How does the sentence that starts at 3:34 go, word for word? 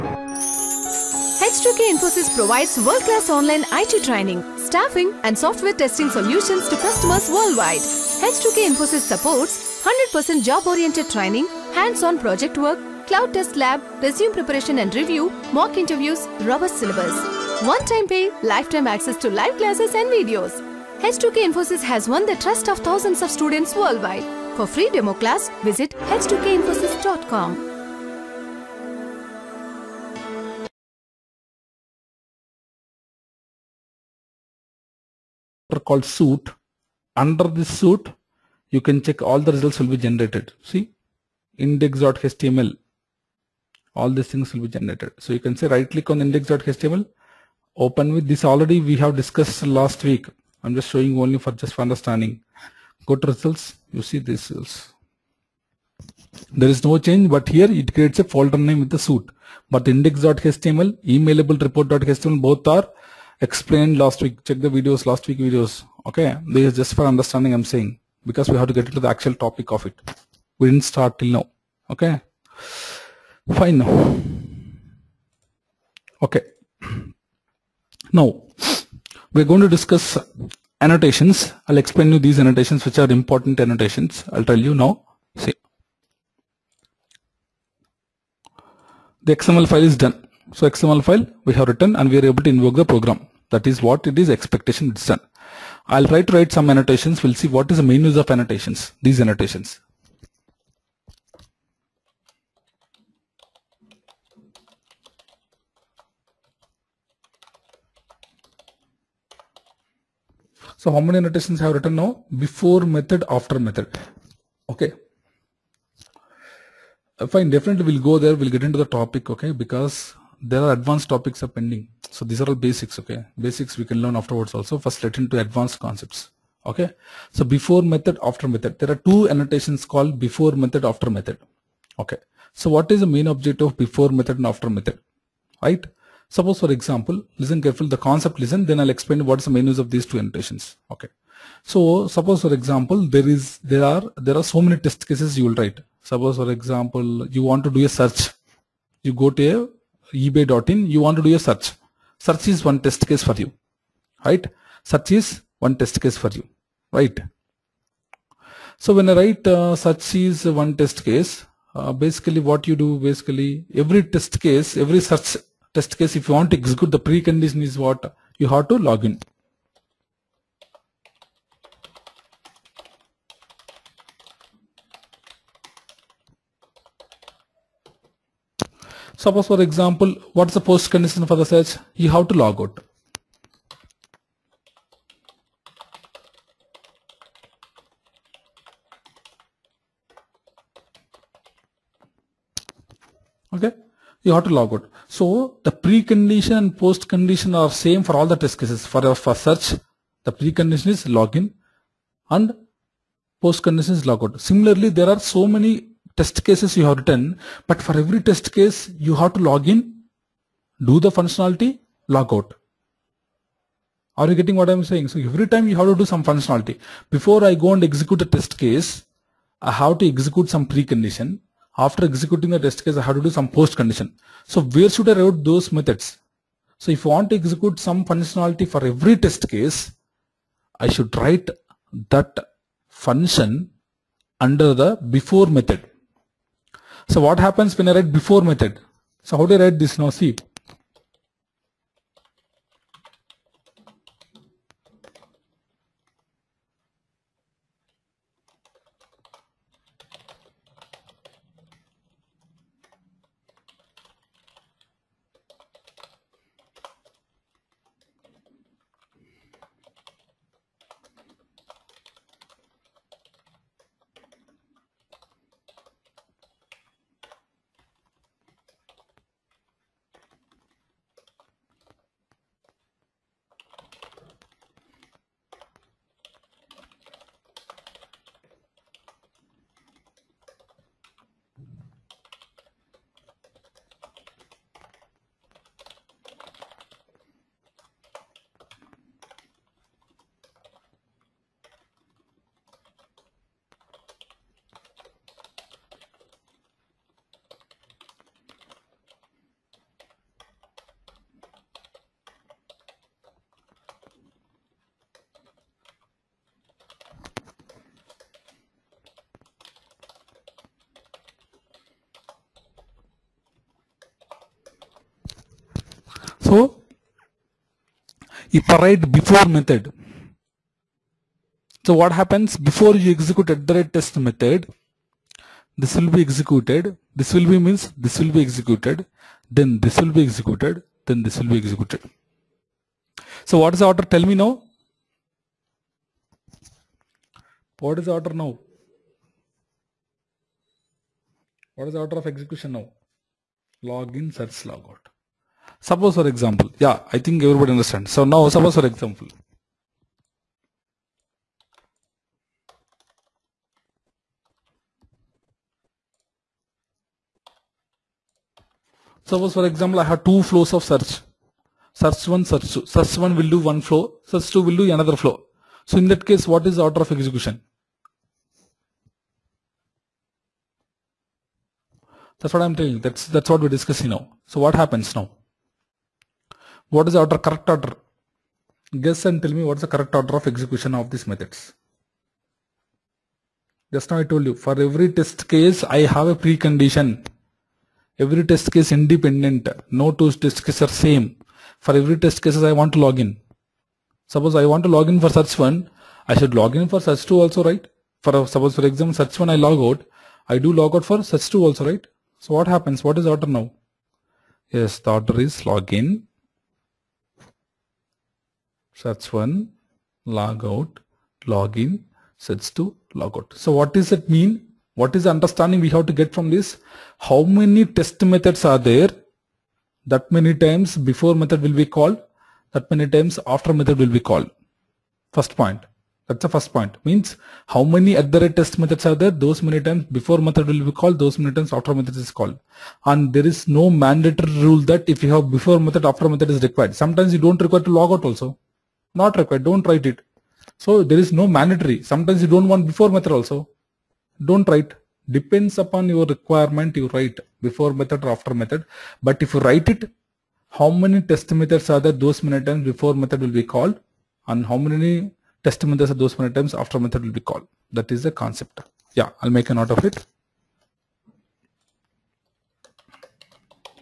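Are you getting what I'm saying?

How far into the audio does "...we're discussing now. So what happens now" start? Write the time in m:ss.
6:13.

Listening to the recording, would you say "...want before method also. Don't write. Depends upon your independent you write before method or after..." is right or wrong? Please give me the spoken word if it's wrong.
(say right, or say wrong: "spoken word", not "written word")
wrong: "requirement", not "independent".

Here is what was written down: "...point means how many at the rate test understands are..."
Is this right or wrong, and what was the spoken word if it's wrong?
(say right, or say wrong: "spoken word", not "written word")
wrong: "methods", not "understands".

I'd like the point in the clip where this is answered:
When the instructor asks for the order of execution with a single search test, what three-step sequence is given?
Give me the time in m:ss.
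5:43.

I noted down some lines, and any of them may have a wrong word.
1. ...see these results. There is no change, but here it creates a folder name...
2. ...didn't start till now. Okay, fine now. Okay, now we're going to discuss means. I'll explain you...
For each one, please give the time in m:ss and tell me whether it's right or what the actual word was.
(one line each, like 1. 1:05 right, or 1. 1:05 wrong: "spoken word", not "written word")
1. 0:54 right
2. 1:10 wrong: "annotations", not "means".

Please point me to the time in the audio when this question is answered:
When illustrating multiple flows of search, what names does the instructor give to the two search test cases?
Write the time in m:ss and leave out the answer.
6:01.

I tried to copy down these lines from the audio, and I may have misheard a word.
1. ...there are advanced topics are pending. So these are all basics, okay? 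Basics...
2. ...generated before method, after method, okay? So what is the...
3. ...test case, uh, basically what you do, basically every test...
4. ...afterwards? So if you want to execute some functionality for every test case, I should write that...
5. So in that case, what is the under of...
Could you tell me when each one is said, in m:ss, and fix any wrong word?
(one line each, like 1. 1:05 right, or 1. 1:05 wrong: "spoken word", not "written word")
1. 2:00 right
2. 2:09 wrong: "called", not "generated"
3. 2:40 right
4. 3:45 wrong: "methods", not "afterwards"
5. 6:05 wrong: "order", not "under".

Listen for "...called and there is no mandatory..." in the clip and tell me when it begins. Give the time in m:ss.
7:12.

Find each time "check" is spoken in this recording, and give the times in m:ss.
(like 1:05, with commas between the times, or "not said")
0:39, 1:04.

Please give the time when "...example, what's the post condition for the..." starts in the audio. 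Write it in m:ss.
2:59.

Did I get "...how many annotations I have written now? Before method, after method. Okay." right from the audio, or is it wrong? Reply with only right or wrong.
right.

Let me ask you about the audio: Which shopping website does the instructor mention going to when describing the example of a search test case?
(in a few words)
ebay.in.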